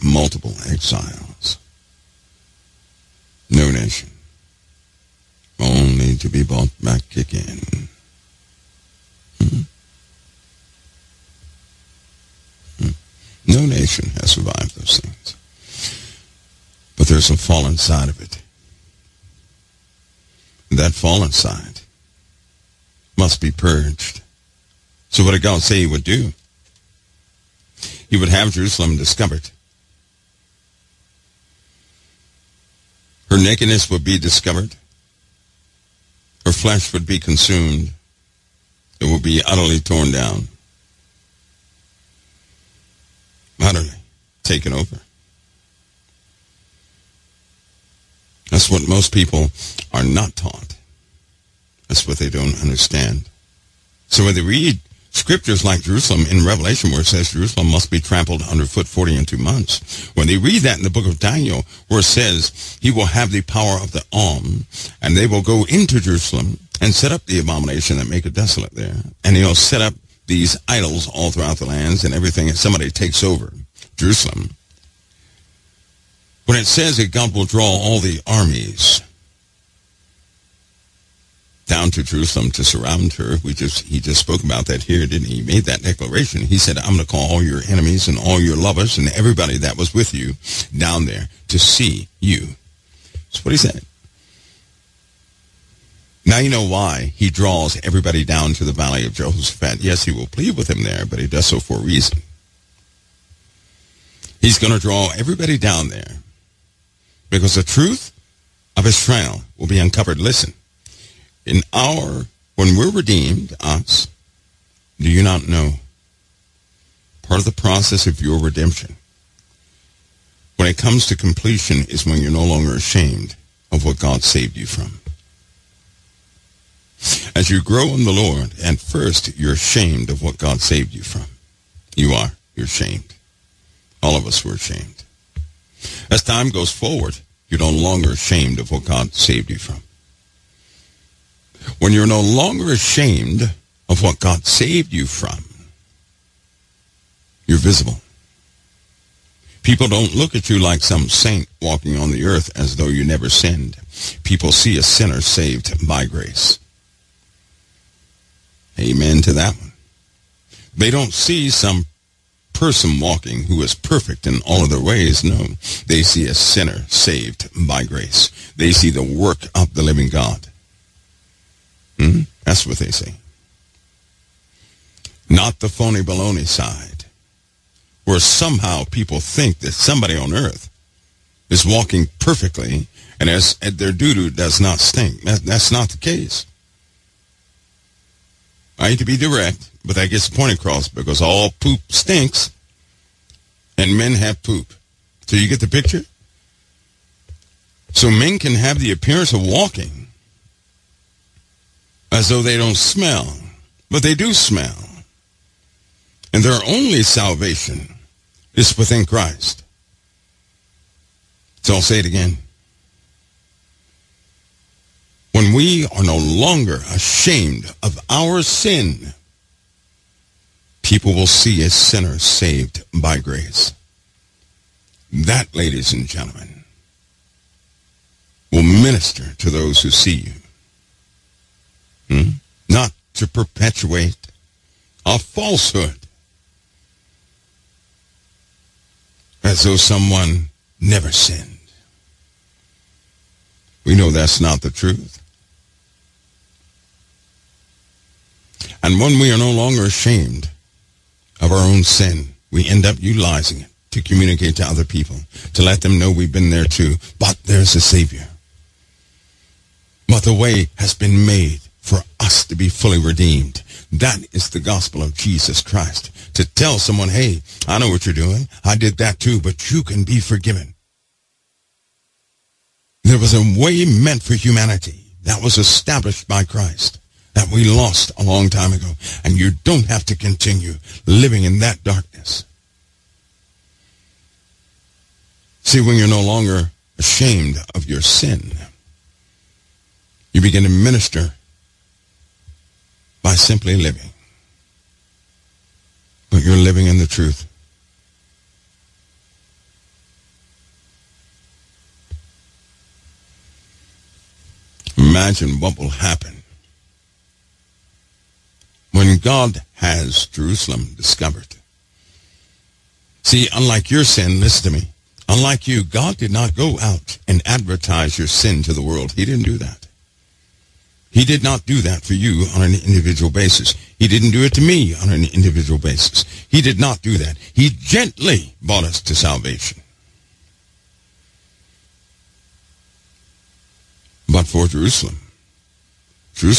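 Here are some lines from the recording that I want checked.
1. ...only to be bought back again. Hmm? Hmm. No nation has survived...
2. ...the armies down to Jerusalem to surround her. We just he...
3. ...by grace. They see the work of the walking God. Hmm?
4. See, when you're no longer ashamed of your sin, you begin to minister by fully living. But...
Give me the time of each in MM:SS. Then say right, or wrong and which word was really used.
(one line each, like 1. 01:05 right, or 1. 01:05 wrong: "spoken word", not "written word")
1. 00:05 right
2. 01:17 right
3. 02:47 wrong: "living", not "walking"
4. 04:45 wrong: "simply", not "fully".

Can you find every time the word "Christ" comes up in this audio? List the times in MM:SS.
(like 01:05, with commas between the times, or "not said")
03:29, 04:25, 04:36.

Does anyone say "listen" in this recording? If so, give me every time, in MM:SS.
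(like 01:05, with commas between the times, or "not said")
01:50, 05:14.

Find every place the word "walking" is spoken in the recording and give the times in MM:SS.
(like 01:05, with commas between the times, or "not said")
02:31, 02:42, 03:01, 03:19.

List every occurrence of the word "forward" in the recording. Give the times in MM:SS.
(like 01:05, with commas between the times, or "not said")
02:16.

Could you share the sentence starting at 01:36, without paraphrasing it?
Now you know why he draws everybody down to the valley of Jehoshaphat.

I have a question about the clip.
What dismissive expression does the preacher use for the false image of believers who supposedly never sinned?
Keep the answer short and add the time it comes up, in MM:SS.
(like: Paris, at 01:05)
Phony baloney, at 02:55.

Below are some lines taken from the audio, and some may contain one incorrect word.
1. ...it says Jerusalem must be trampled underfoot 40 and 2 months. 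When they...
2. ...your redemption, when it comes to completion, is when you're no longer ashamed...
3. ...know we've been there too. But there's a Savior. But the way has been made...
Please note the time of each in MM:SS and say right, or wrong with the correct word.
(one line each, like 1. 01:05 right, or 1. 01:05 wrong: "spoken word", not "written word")
1. 00:57 right
2. 01:58 right
3. 04:15 right.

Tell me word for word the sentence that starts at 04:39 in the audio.
And you don't have to continue living in that darkness.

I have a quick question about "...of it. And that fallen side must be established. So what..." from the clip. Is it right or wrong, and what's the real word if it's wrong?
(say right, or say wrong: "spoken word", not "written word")
wrong: "purged", not "established".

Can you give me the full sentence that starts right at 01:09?
And he'll set up these idols all throughout the lands and everything and somebody takes over Jerusalem.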